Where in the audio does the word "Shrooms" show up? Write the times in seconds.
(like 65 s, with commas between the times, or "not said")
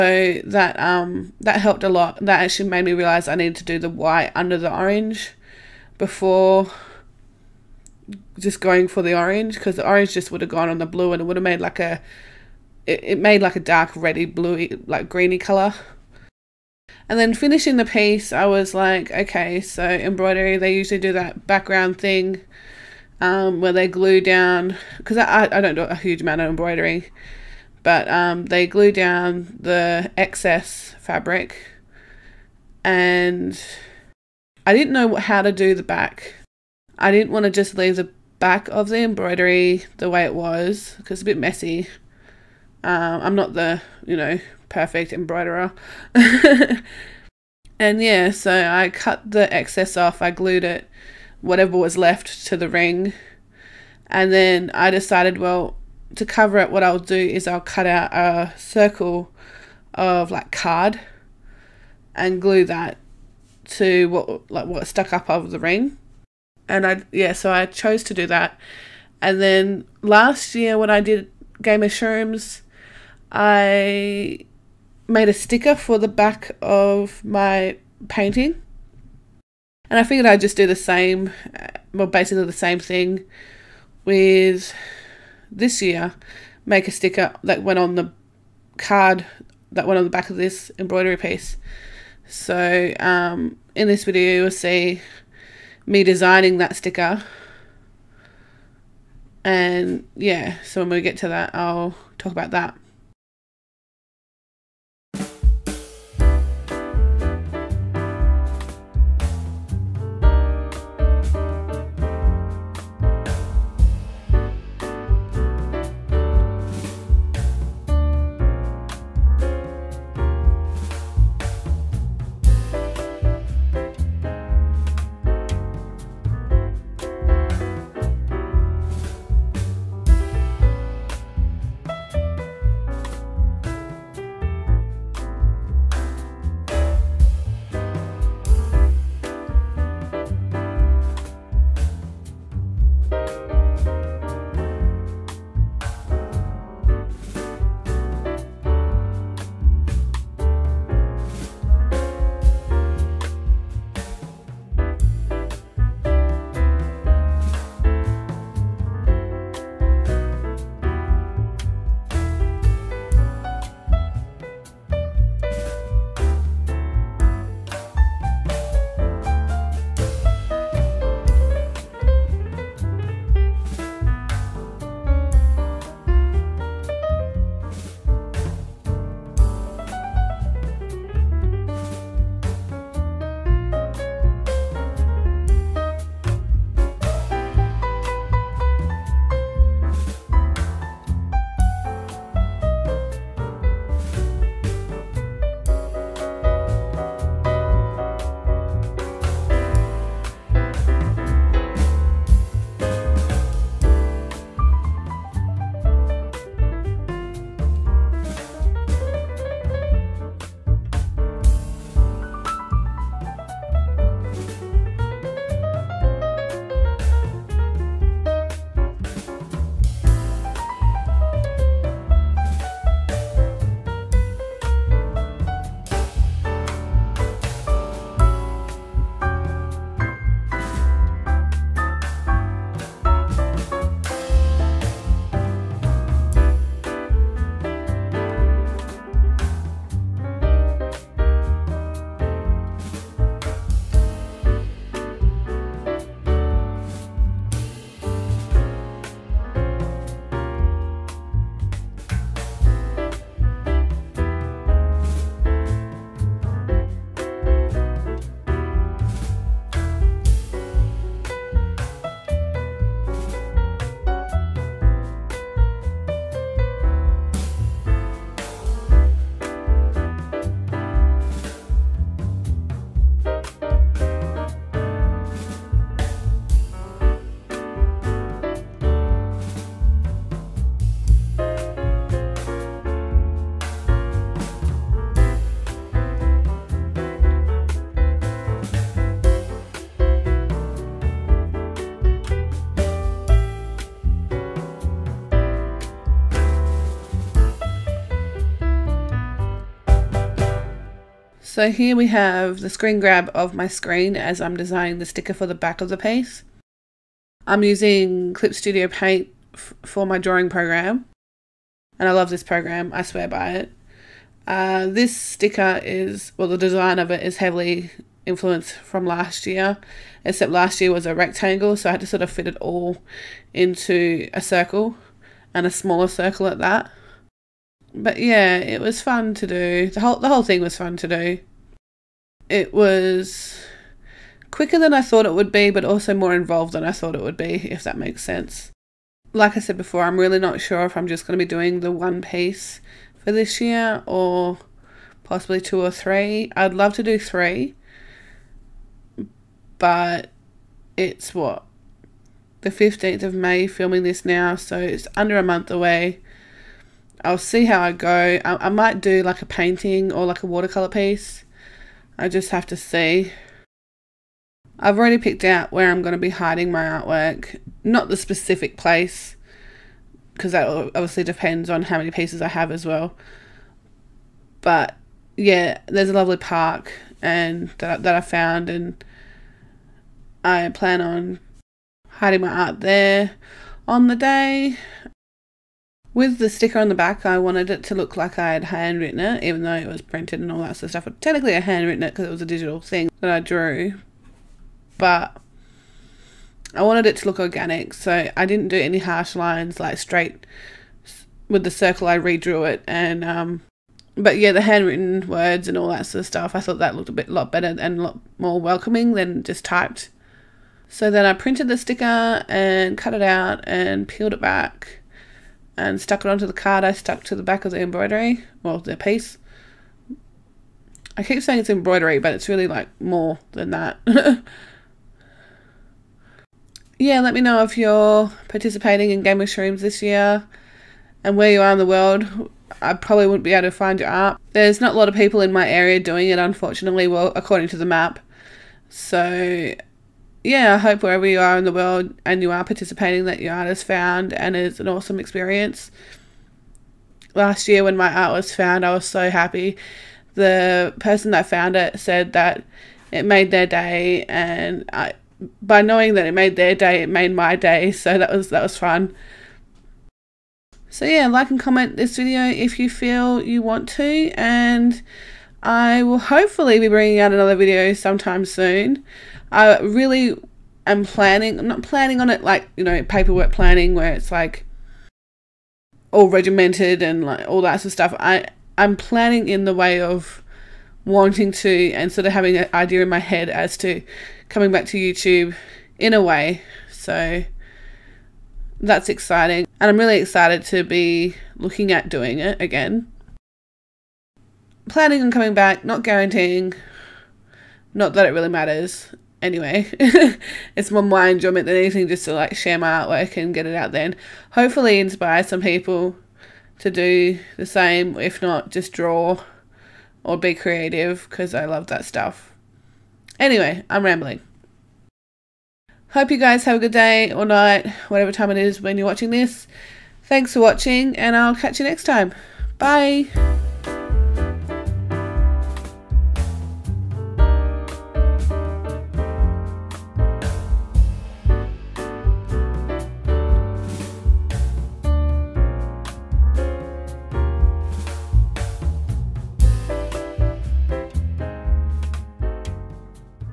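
71 s, 429 s.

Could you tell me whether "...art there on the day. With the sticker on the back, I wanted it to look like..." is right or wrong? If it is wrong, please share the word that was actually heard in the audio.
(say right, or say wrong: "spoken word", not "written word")
right.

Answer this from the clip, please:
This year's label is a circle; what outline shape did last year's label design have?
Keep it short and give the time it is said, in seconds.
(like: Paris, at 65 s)
rectangle, at 321 s.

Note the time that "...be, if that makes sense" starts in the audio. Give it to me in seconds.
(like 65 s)
337 s.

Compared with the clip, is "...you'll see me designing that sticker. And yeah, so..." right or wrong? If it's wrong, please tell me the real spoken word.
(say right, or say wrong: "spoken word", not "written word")
right.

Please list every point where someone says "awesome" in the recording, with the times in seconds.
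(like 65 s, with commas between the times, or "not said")
444 s.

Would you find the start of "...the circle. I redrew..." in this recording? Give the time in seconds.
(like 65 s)
401 s.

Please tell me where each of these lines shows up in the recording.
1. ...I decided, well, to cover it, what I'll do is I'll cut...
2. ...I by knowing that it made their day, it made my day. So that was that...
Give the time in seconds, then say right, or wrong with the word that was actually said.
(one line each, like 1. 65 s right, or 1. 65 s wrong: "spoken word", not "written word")
1. 54 s right
2. 454 s right.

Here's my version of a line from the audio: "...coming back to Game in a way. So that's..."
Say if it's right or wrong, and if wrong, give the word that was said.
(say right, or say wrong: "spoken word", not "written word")
wrong: "YouTube", not "Game".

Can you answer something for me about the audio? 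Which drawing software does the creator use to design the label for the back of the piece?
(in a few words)
Clip Studio Paint.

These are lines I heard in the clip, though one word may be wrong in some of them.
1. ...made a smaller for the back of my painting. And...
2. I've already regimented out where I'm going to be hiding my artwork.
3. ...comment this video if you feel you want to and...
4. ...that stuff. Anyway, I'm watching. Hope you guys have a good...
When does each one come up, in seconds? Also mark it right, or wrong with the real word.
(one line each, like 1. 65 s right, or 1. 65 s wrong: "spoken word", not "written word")
1. 75 s wrong: "sticker", not "smaller"
2. 364 s wrong: "picked", not "regimented"
3. 461 s right
4. 511 s wrong: "rambling", not "watching".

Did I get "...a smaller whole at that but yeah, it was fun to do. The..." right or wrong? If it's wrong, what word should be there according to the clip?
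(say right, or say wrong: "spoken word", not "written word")
wrong: "circle", not "whole".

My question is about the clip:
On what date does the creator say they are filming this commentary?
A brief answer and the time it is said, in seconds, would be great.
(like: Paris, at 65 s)
15th of May, at 352 s.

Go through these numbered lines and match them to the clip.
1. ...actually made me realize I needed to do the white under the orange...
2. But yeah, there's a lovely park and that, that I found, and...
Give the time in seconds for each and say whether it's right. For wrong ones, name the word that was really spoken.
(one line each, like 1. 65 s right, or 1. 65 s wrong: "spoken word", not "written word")
1. 2 s right
2. 374 s right.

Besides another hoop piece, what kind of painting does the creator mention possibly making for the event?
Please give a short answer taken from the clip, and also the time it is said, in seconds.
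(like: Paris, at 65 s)
watercolor, at 360 s.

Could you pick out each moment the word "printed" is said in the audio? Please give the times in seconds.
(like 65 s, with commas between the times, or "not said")
390 s, 411 s.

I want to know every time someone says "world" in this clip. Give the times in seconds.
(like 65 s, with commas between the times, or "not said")
431 s, 441 s.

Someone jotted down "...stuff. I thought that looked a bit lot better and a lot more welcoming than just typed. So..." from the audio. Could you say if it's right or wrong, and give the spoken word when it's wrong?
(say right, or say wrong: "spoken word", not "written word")
right.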